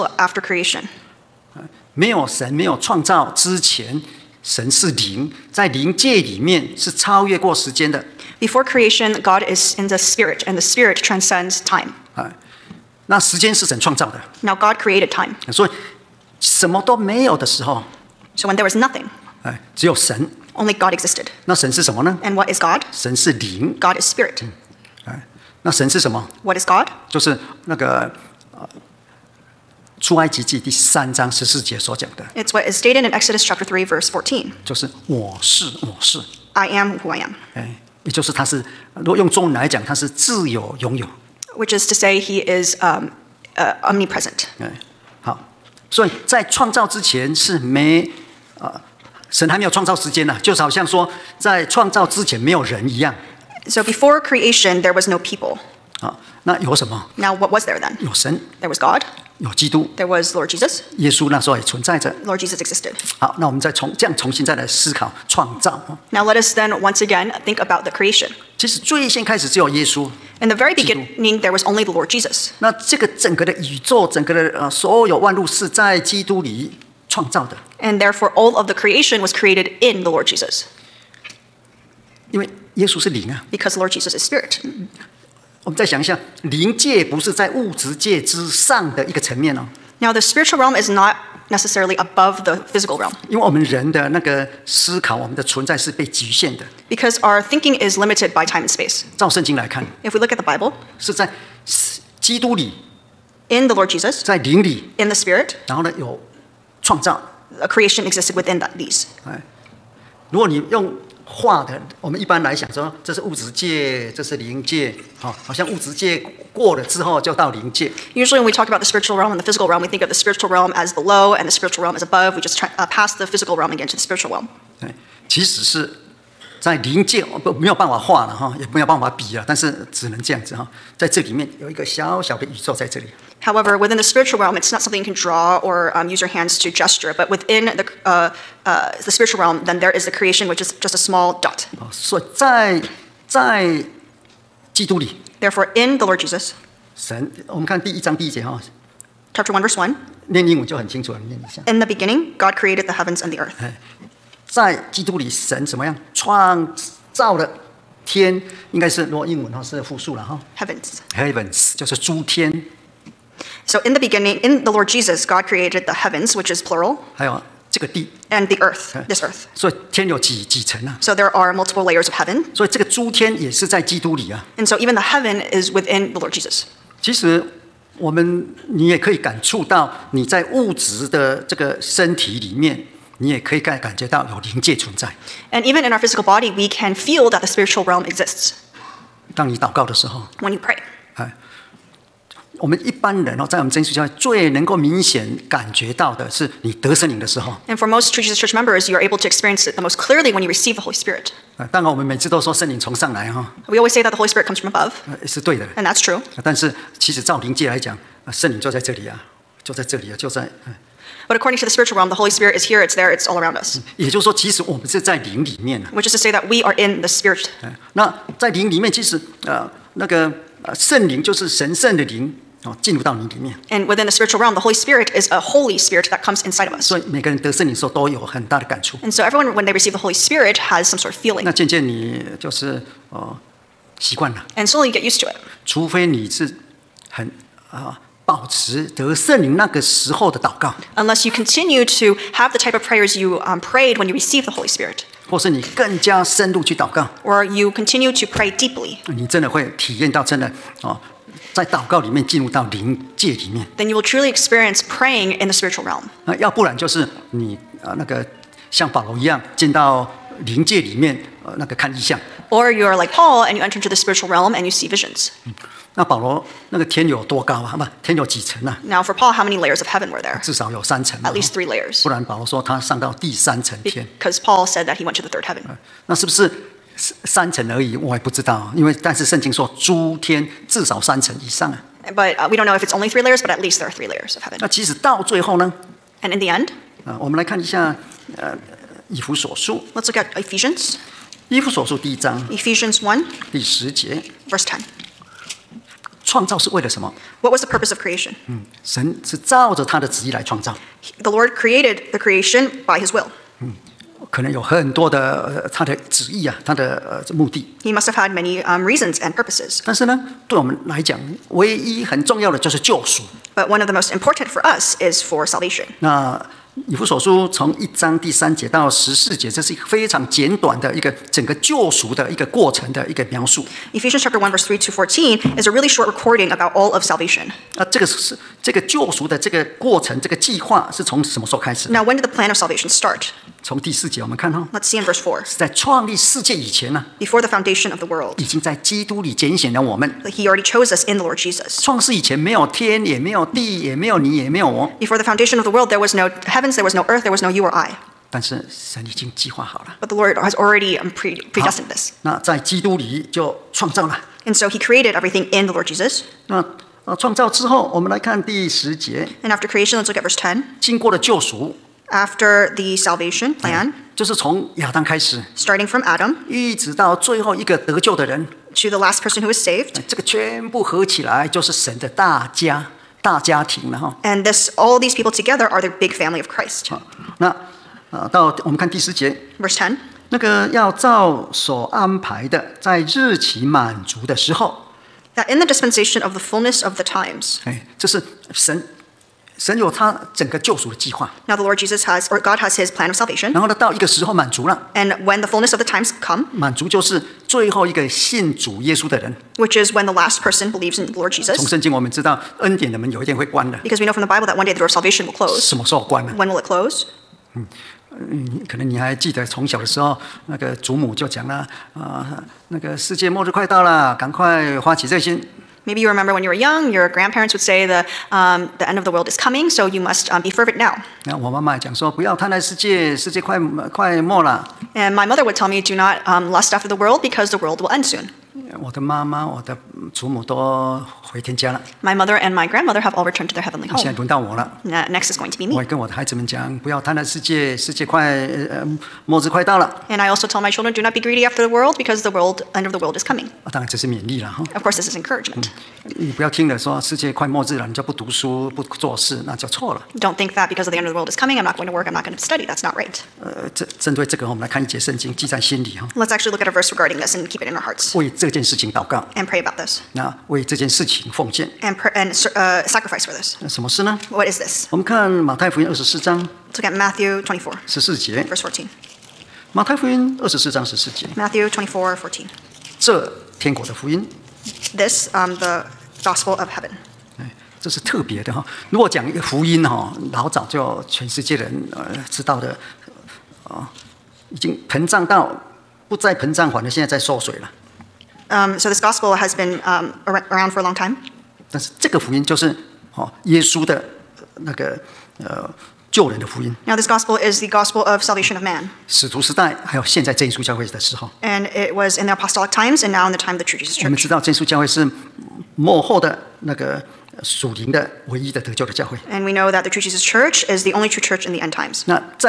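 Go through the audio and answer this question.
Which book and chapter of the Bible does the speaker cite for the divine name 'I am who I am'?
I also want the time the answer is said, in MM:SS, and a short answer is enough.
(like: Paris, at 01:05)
Exodus chapter 3, at 00:33.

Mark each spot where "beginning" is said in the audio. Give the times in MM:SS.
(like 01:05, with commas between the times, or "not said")
01:10, 02:31, 02:43.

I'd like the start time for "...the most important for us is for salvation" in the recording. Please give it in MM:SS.
05:13.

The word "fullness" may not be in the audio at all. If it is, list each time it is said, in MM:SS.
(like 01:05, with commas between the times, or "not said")
06:26, 06:35.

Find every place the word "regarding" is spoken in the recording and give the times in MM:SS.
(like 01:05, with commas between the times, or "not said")
07:36.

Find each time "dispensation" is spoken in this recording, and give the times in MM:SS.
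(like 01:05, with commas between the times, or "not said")
06:25.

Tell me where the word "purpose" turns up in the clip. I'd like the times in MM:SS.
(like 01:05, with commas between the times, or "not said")
04:57, 05:09.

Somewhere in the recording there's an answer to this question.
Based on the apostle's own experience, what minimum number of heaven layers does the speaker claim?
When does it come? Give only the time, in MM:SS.
04:31.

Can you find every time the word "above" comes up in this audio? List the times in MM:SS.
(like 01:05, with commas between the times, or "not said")
01:31, 02:02, 03:24.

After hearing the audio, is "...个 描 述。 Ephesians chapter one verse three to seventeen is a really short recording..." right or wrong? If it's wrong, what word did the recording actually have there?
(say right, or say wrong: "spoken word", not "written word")
wrong: "fourteen", not "seventeen".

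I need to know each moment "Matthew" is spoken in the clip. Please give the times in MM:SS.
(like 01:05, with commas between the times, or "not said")
07:46, 07:51.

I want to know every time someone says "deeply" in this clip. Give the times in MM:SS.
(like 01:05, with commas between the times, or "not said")
04:08.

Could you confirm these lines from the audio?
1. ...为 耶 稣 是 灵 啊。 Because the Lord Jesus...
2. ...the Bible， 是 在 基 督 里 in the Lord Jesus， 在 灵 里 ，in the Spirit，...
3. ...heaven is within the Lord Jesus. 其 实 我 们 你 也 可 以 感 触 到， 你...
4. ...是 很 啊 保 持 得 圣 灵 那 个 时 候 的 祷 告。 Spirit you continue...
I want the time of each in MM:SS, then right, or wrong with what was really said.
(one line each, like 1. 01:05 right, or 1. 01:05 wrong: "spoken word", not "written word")
1. 01:22 right
2. 01:40 right
3. 02:55 right
4. 03:56 wrong: "Unless", not "Spirit".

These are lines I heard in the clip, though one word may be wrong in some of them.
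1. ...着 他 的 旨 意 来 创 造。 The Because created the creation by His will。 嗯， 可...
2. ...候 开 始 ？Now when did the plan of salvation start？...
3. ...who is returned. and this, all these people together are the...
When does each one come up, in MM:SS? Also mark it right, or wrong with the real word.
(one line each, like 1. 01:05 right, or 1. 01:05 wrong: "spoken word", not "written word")
1. 04:59 wrong: "Lord", not "Because"
2. 05:31 right
3. 06:09 wrong: "saved", not "returned".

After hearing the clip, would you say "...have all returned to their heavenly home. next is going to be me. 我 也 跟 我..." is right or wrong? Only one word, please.
right.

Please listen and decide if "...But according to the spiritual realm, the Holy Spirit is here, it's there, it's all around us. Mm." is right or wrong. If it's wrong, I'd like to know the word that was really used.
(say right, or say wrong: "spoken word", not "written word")
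right.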